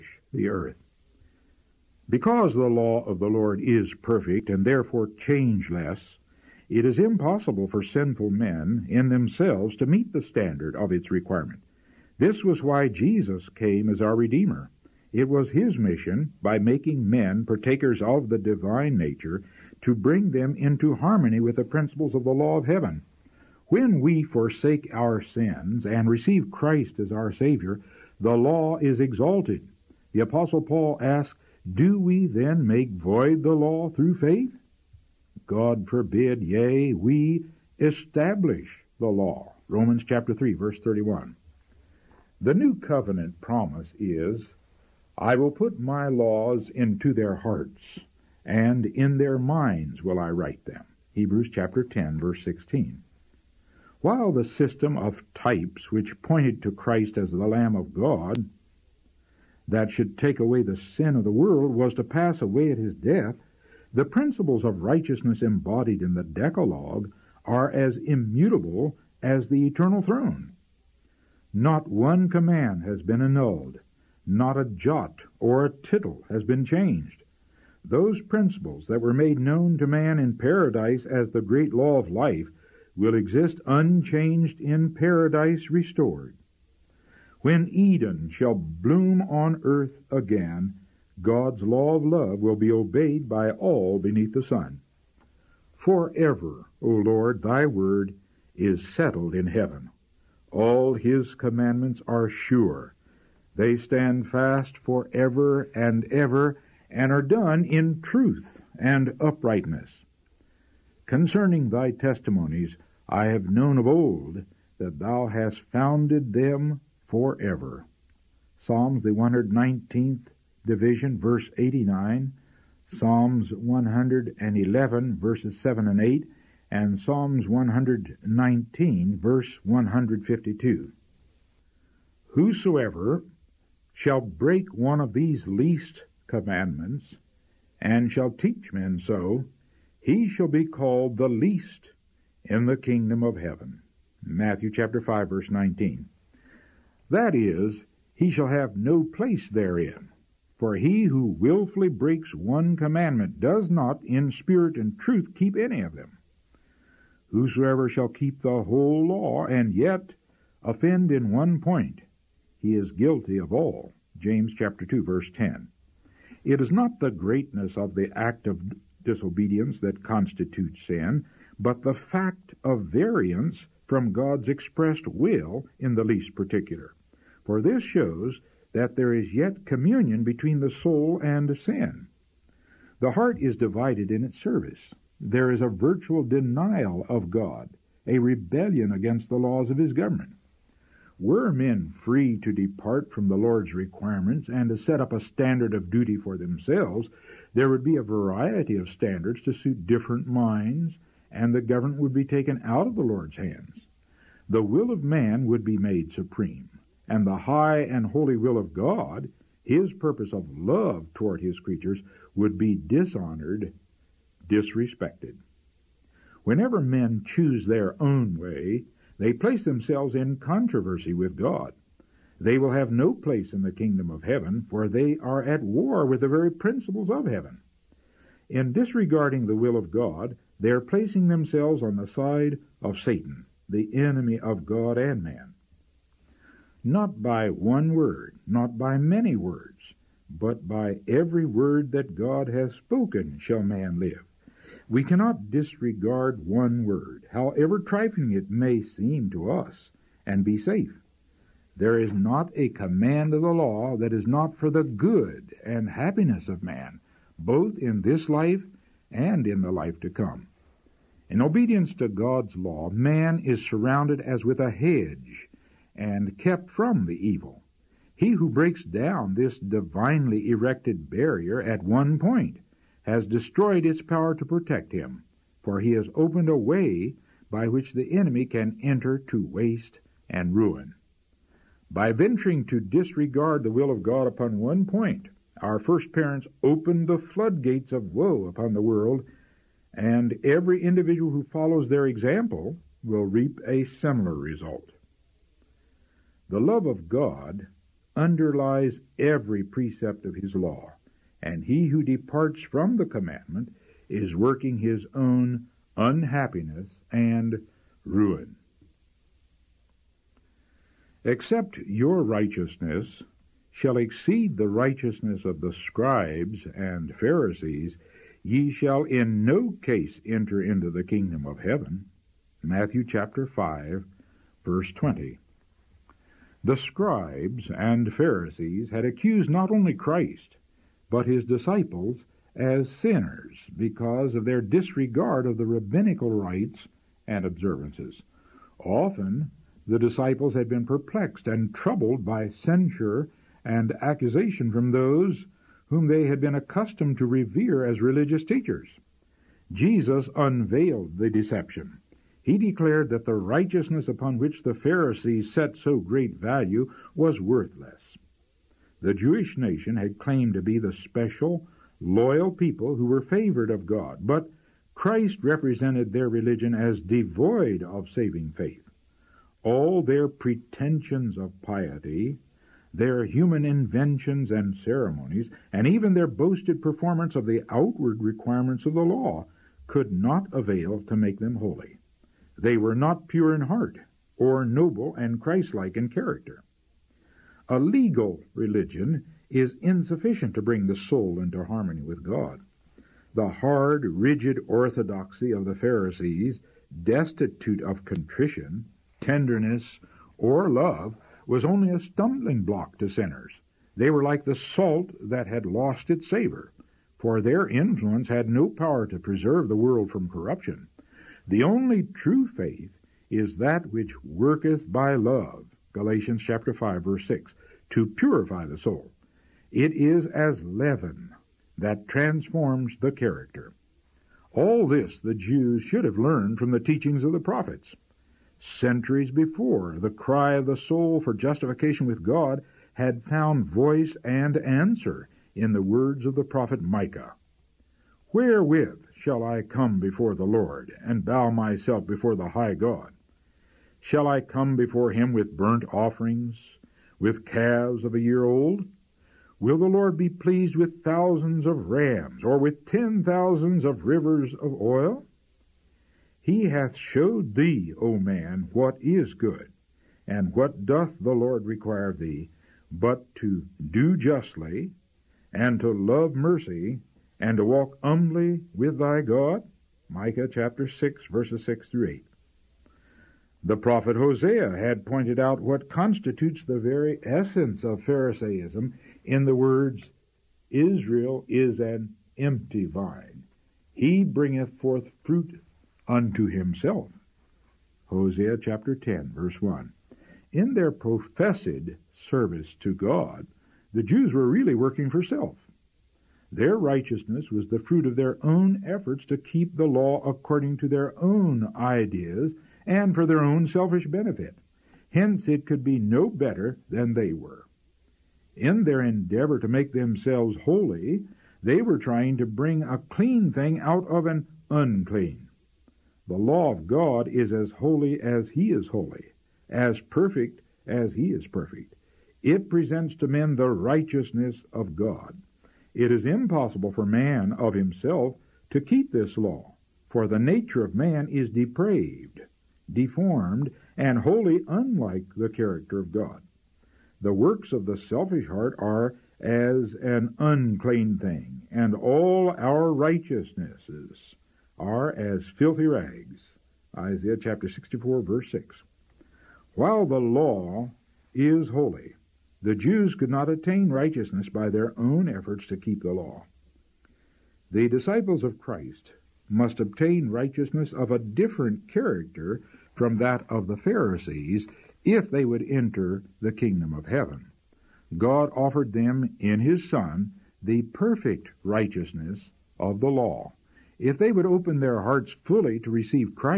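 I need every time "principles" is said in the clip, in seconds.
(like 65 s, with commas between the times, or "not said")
21 s, 64 s, 78 s, 226 s.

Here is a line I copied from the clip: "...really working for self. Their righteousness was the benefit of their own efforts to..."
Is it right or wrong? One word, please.
wrong.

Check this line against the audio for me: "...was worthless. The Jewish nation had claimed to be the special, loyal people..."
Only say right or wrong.
right.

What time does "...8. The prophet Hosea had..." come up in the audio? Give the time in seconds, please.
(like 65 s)
472 s.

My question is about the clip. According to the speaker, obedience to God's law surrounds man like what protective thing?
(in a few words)
A hedge.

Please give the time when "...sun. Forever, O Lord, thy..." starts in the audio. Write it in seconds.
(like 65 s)
94 s.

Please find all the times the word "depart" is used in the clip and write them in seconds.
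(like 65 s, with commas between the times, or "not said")
192 s, 302 s.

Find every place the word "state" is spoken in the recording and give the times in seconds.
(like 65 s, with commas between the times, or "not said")
not said.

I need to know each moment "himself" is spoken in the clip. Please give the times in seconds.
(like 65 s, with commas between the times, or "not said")
486 s, 527 s.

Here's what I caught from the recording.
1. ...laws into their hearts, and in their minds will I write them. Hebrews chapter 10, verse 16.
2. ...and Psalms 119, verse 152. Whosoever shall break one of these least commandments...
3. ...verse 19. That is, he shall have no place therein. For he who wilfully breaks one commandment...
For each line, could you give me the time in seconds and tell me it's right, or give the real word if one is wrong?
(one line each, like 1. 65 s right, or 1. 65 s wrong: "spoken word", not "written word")
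1. 46 s right
2. 126 s right
3. 145 s right.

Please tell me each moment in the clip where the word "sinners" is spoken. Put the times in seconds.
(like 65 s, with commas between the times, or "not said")
332 s, 403 s.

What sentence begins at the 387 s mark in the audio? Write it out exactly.
A legal religion is insufficient to bring the soul into harmony with God.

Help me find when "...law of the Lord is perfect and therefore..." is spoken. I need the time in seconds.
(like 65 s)
2 s.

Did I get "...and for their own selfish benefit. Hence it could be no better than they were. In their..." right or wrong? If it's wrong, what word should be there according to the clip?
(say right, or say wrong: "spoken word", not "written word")
right.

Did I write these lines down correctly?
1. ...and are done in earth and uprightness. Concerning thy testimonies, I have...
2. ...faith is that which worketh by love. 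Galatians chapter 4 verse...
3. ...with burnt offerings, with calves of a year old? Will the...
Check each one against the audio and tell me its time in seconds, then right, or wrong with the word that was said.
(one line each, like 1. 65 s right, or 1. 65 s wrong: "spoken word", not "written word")
1. 106 s wrong: "truth", not "earth"
2. 412 s wrong: "5", not "4"
3. 445 s right.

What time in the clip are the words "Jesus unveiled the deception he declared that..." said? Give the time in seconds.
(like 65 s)
349 s.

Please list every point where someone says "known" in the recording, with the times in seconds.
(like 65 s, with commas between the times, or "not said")
79 s, 113 s.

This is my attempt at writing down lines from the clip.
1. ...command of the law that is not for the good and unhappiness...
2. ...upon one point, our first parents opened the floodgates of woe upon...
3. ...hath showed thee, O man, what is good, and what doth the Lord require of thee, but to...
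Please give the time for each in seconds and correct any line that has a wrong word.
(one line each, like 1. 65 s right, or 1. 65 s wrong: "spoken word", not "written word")
1. 252 s wrong: "happiness", not "unhappiness"
2. 284 s right
3. 456 s right.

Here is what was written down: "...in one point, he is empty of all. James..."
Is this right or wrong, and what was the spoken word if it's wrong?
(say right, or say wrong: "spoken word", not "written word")
wrong: "guilty", not "empty".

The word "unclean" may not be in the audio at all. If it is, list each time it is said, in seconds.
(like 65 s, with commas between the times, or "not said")
514 s, 540 s.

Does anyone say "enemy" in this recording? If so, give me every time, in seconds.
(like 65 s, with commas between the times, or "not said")
233 s, 278 s.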